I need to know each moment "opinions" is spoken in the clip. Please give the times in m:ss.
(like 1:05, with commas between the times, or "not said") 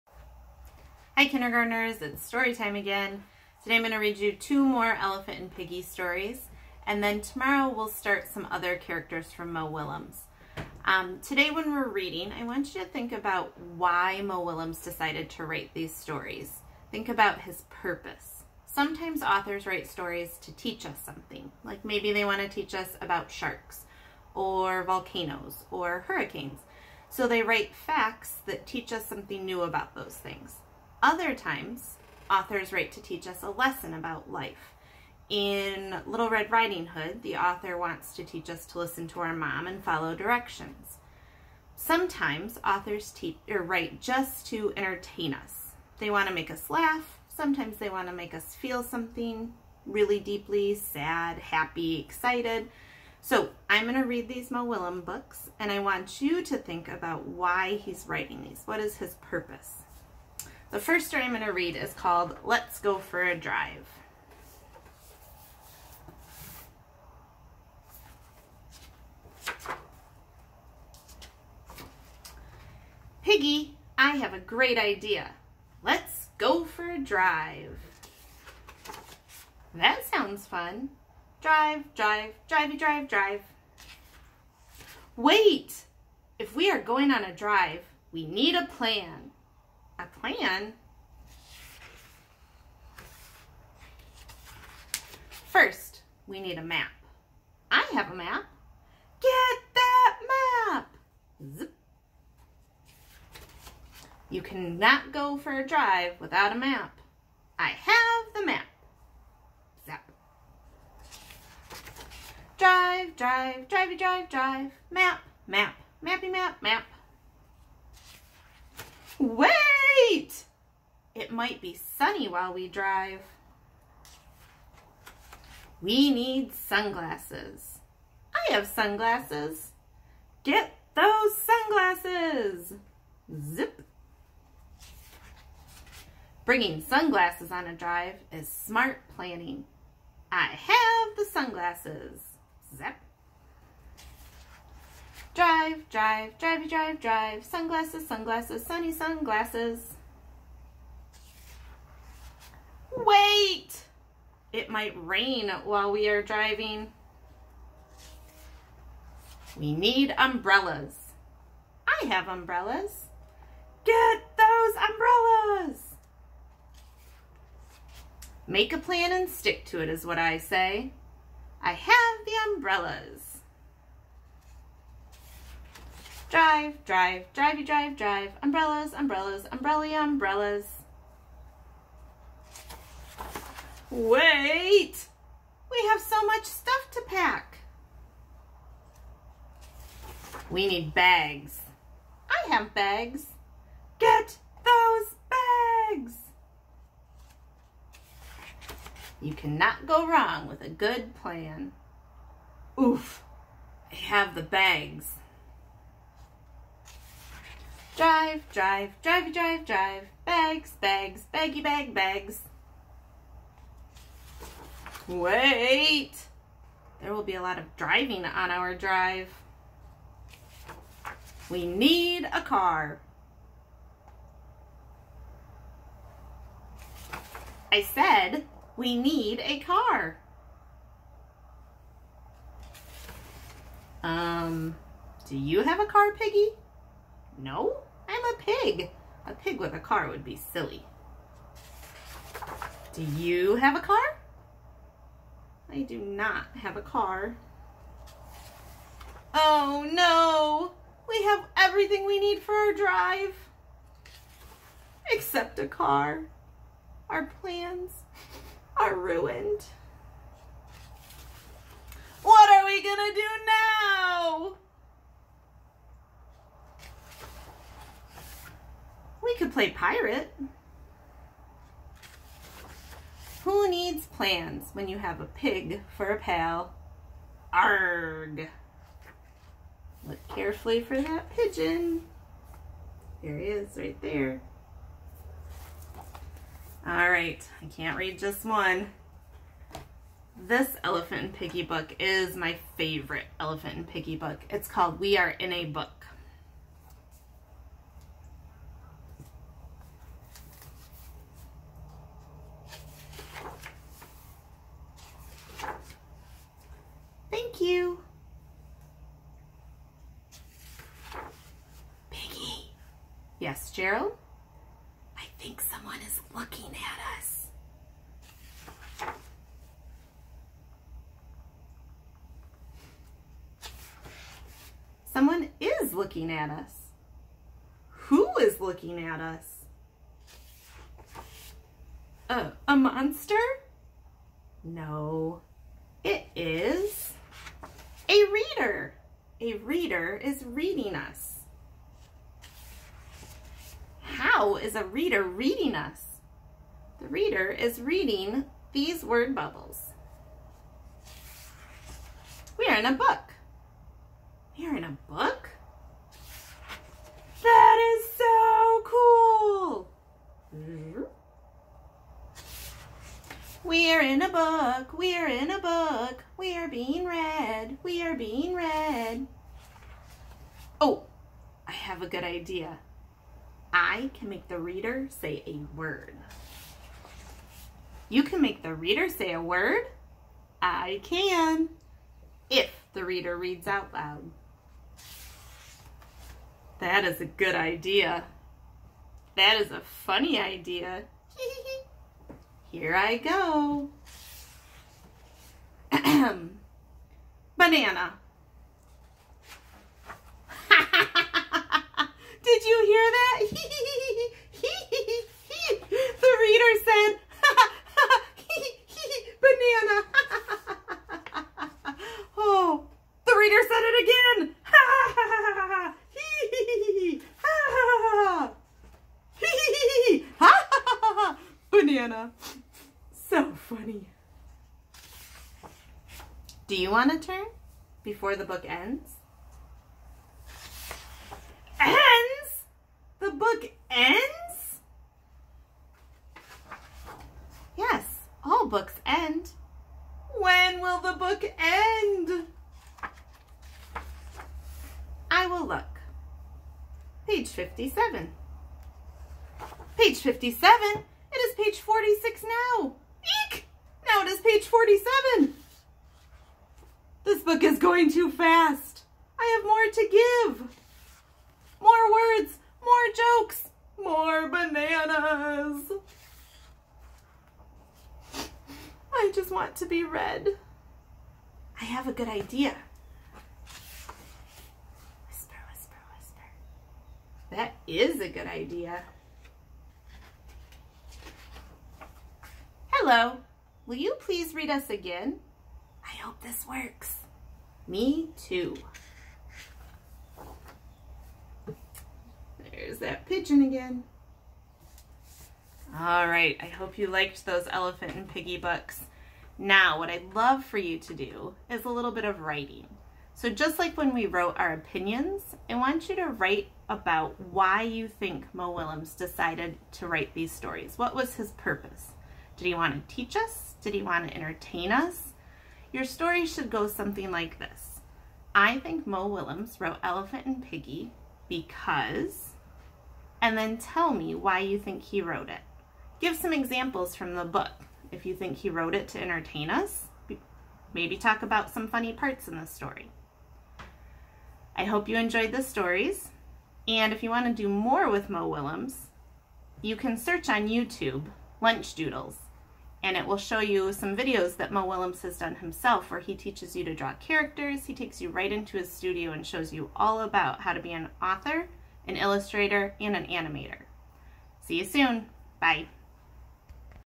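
8:24.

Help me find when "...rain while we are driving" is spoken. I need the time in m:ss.
2:35.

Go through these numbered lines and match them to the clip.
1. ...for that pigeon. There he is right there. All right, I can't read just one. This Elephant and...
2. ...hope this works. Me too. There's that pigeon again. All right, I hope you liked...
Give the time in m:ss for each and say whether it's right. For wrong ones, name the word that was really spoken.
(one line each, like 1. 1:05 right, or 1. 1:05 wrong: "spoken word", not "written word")
1. 4:40 right
2. 8:06 right.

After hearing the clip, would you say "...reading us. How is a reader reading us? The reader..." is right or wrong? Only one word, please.
right.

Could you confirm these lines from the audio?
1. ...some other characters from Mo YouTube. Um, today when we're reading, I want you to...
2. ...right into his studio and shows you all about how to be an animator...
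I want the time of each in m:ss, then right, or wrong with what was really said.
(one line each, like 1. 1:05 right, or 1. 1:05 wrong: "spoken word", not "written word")
1. 0:08 wrong: "Willems", not "YouTube"
2. 9:08 wrong: "author", not "animator".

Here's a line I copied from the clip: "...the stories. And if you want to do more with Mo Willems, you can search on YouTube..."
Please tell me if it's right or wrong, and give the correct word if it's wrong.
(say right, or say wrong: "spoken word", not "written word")
right.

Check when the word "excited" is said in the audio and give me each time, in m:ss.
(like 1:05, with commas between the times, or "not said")
0:51.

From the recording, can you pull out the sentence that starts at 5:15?
I think someone is looking at us.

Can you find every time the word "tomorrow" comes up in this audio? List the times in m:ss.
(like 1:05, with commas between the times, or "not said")
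0:07.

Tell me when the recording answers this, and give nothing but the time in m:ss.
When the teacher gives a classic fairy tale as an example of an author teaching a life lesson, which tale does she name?
0:36.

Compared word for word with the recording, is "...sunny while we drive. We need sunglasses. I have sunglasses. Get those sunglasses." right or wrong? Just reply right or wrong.
right.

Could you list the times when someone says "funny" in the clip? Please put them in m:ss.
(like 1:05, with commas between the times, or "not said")
6:30, 7:03, 8:51.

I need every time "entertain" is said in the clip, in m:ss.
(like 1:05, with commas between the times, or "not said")
0:44, 8:34, 8:49.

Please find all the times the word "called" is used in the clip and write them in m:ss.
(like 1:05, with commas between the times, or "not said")
1:01, 4:54.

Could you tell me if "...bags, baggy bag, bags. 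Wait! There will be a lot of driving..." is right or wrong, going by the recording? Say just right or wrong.
right.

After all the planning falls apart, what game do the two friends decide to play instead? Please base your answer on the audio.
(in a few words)
Pirate.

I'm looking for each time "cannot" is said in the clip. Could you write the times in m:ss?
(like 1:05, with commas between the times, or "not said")
1:44, 3:19.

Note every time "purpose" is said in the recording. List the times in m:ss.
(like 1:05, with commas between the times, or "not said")
0:17, 0:59, 8:31.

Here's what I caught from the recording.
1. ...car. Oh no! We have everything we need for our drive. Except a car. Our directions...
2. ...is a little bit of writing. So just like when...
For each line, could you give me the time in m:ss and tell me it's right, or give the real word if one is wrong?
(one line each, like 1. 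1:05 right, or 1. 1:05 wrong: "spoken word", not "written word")
1. 4:06 wrong: "plans", not "directions"
2. 8:21 right.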